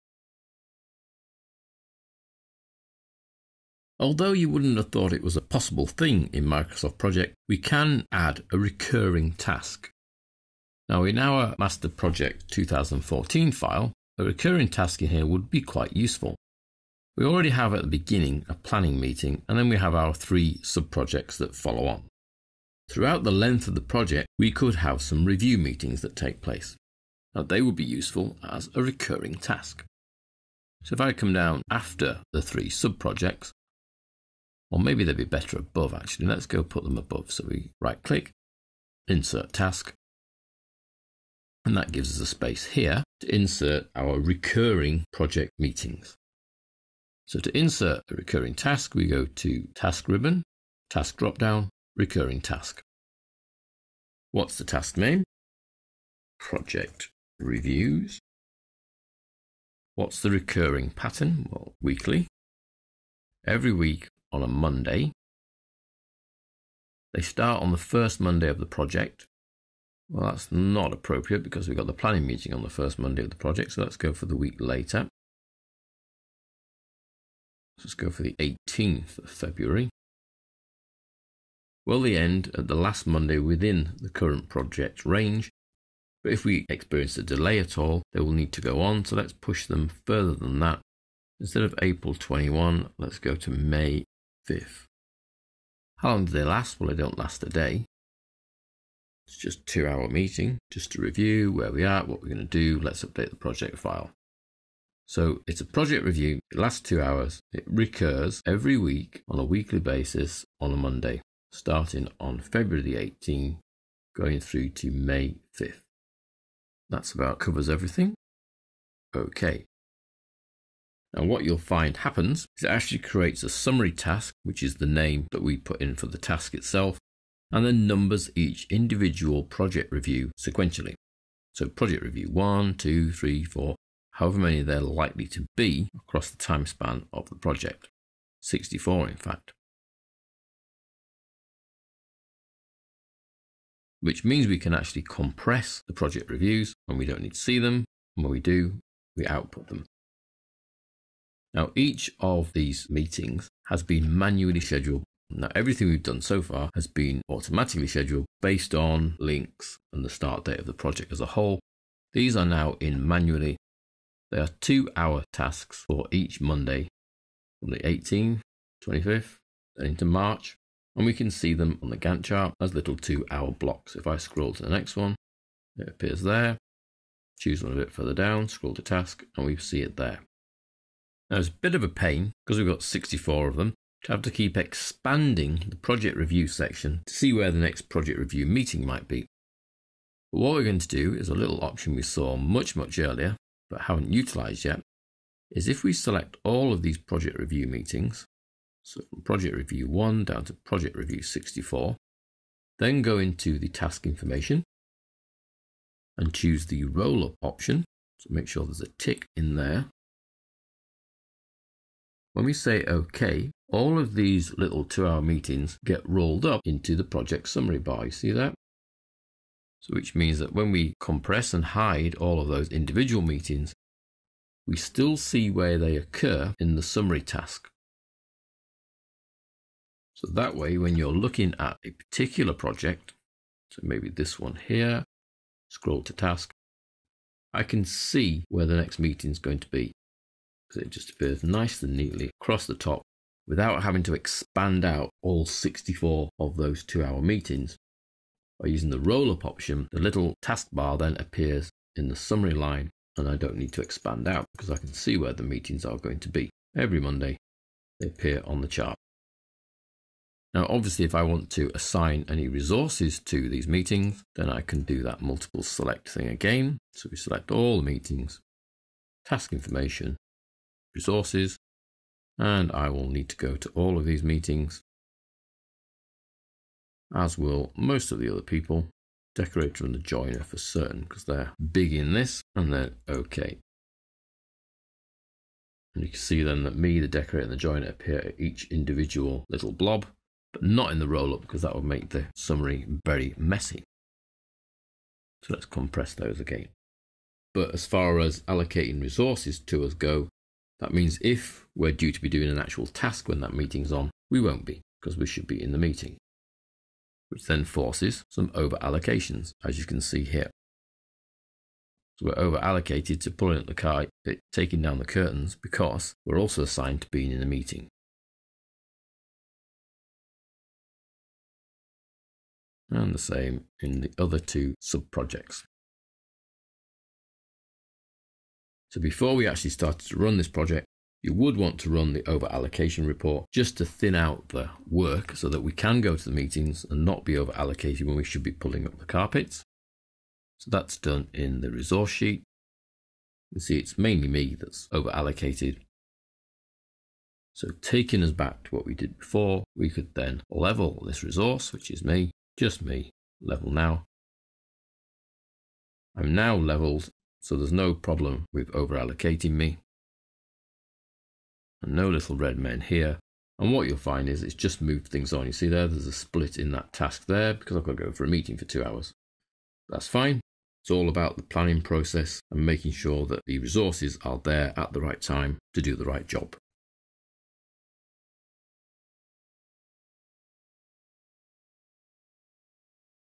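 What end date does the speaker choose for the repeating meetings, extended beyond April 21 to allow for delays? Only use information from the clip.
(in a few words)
May 5th.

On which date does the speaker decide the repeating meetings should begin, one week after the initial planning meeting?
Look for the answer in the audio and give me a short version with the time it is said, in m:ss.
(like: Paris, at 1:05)
18th of February, at 1:18.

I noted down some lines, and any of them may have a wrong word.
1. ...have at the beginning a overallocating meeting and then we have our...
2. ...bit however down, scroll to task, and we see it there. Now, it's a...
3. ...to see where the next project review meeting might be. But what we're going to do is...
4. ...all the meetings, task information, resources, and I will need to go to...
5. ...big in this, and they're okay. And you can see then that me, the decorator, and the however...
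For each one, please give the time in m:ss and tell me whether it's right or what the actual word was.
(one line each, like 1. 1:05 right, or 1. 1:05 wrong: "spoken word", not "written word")
1. 0:17 wrong: "planning", not "overallocating"
2. 2:57 wrong: "further", not "however"
3. 3:07 right
4. 4:27 right
5. 4:41 wrong: "joiner", not "however".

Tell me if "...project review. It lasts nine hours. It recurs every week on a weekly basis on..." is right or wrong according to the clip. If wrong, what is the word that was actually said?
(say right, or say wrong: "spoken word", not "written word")
wrong: "two", not "nine".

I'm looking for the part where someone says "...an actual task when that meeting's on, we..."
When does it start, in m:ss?
5:02.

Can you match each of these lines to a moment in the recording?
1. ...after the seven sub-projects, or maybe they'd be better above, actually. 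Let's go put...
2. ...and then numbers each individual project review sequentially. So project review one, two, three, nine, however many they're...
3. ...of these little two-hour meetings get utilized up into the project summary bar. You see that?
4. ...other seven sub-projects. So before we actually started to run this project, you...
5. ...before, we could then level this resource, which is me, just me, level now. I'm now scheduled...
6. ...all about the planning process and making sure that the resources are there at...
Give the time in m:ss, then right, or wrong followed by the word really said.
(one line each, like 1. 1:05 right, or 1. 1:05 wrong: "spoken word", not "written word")
1. 0:31 wrong: "three", not "seven"
2. 2:07 wrong: "four", not "nine"
3. 3:33 wrong: "rolled", not "utilized"
4. 5:24 wrong: "two", not "seven"
5. 5:49 wrong: "leveled", not "scheduled"
6. 6:10 right.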